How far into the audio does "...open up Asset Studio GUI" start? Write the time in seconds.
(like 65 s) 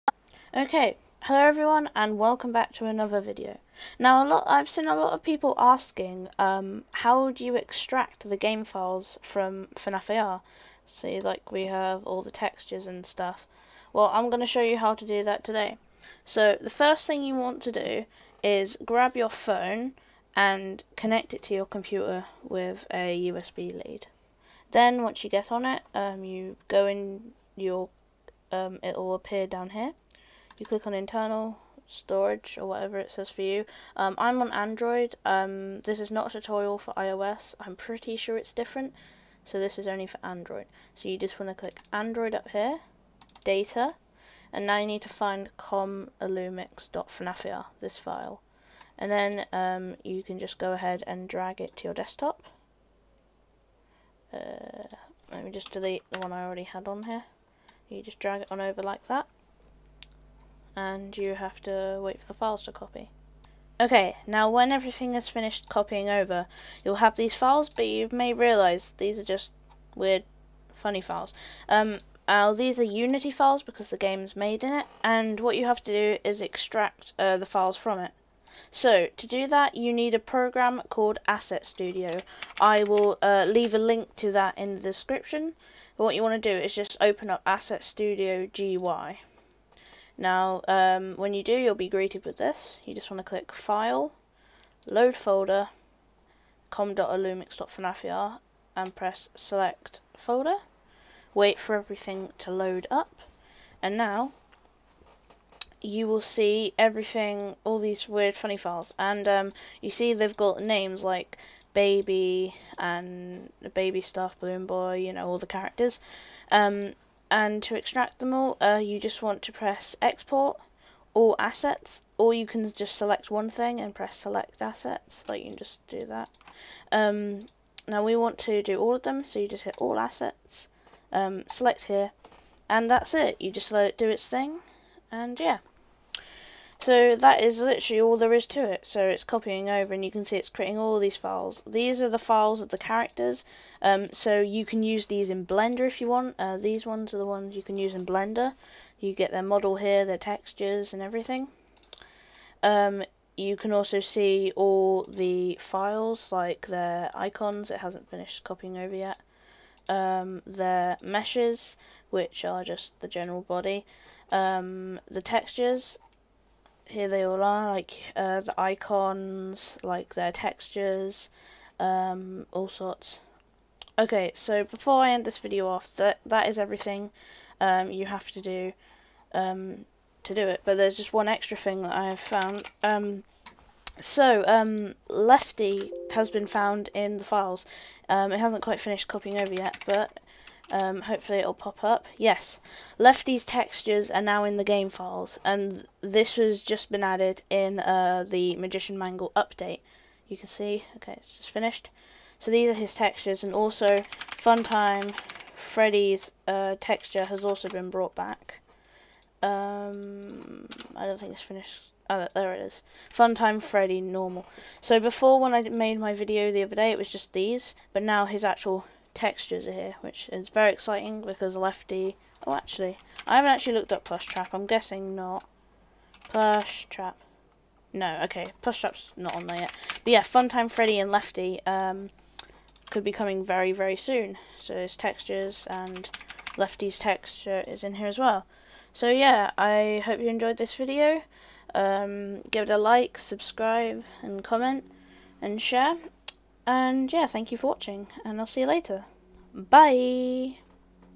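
87 s.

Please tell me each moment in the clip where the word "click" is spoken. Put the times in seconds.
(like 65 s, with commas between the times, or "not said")
30 s, 41 s, 93 s.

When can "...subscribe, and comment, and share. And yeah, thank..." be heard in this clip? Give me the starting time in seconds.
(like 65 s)
243 s.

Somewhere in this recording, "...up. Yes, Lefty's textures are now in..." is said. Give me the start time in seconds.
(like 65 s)
191 s.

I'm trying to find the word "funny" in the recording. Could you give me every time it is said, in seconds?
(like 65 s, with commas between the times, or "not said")
70 s, 108 s.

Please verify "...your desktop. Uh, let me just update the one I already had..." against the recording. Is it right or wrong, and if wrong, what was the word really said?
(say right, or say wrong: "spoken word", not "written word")
wrong: "delete", not "update".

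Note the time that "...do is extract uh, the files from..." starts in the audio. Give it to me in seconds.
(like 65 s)
75 s.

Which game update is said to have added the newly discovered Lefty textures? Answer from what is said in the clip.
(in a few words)
Magician Mangle update.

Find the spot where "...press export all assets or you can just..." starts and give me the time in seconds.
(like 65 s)
119 s.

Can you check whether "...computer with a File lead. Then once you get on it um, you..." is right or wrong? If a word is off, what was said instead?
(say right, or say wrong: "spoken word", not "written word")
wrong: "USB", not "File".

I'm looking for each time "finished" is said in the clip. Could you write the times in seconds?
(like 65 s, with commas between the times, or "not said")
65 s, 158 s, 188 s, 201 s, 211 s.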